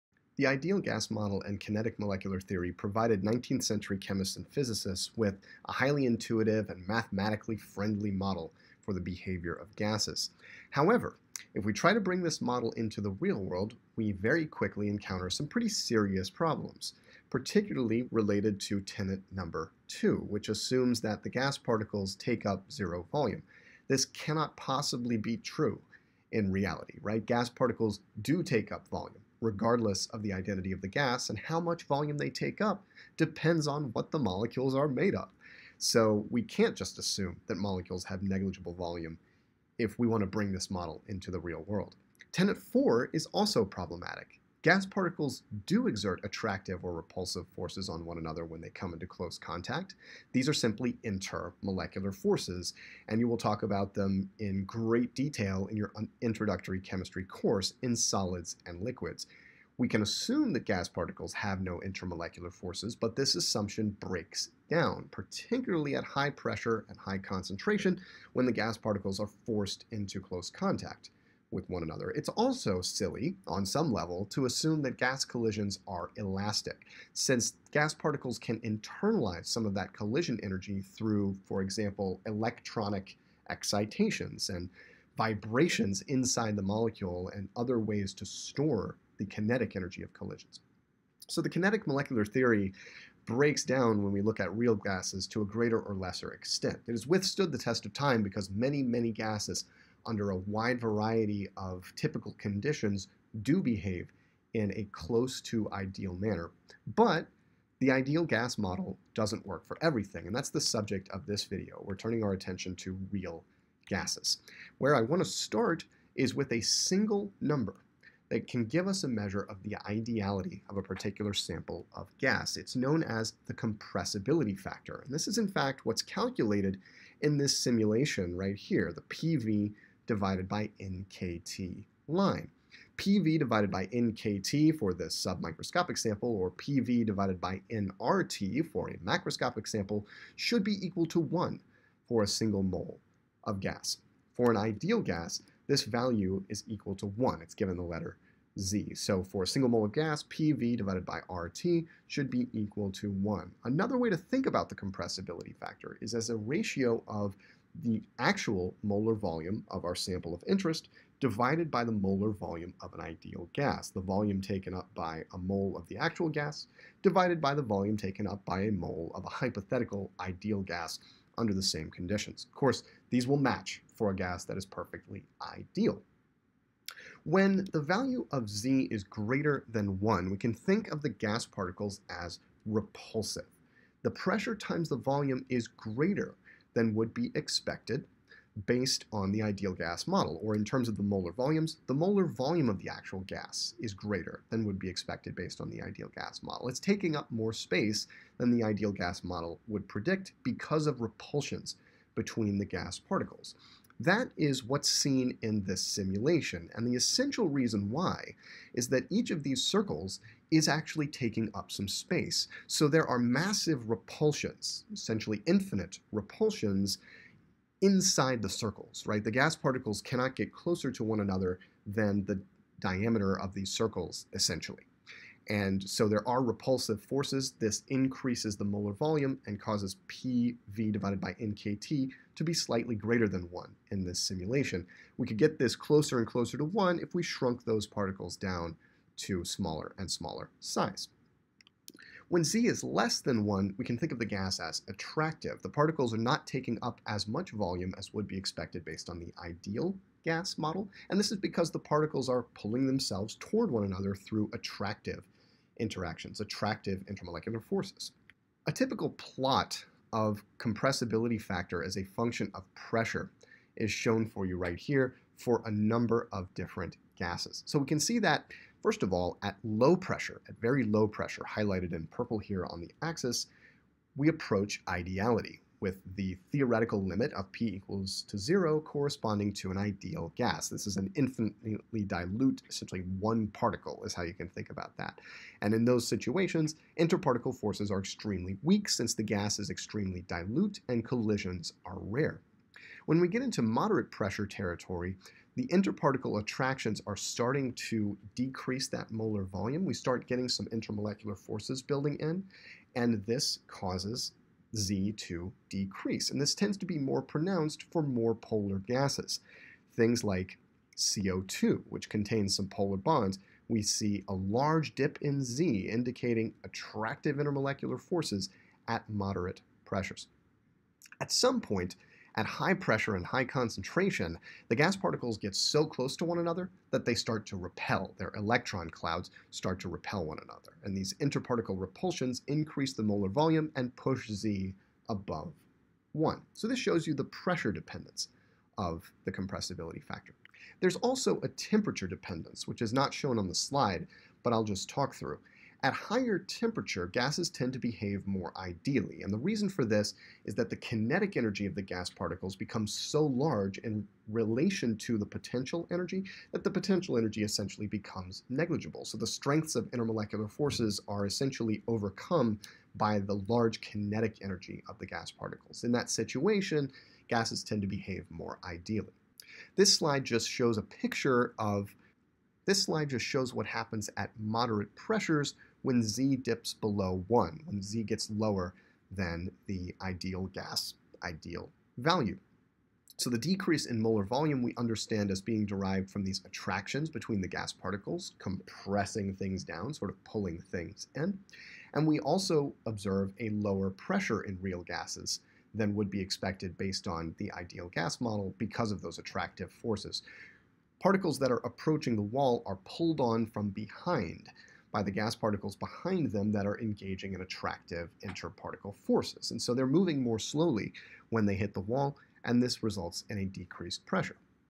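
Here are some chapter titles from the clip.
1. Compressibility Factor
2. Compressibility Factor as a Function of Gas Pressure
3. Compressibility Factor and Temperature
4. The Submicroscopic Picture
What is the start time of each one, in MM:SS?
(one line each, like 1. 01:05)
1. 01:54
2. 04:18
3. 05:41
4. 06:12.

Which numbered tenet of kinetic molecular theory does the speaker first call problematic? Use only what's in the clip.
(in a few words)
2.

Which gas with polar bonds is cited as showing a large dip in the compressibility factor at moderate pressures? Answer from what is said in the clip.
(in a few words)
CO2.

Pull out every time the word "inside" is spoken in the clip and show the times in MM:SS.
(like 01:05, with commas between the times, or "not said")
01:26, 03:37.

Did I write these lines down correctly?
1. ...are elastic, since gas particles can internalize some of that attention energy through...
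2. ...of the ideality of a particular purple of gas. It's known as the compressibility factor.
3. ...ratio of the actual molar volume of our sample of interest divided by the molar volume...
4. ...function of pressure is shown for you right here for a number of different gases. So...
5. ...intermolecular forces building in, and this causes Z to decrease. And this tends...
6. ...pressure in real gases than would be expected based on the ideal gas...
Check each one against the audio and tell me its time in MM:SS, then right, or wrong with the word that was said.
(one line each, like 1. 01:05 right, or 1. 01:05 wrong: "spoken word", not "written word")
1. 01:15 wrong: "collision", not "attention"
2. 01:59 wrong: "sample", not "purple"
3. 02:36 right
4. 04:22 right
5. 05:00 right
6. 06:33 right.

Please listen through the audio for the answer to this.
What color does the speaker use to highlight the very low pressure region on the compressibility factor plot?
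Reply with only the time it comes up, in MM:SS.
04:32.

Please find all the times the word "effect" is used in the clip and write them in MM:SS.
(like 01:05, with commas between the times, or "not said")
not said.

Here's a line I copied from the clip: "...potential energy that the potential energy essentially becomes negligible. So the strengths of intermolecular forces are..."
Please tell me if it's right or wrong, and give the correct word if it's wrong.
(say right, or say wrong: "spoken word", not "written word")
right.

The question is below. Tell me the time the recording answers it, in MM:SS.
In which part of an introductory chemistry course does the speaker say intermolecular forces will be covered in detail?
00:57.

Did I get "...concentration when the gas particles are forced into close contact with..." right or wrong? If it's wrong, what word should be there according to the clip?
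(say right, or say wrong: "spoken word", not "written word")
right.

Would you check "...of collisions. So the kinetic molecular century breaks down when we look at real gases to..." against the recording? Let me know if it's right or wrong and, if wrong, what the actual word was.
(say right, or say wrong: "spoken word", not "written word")
wrong: "theory", not "century".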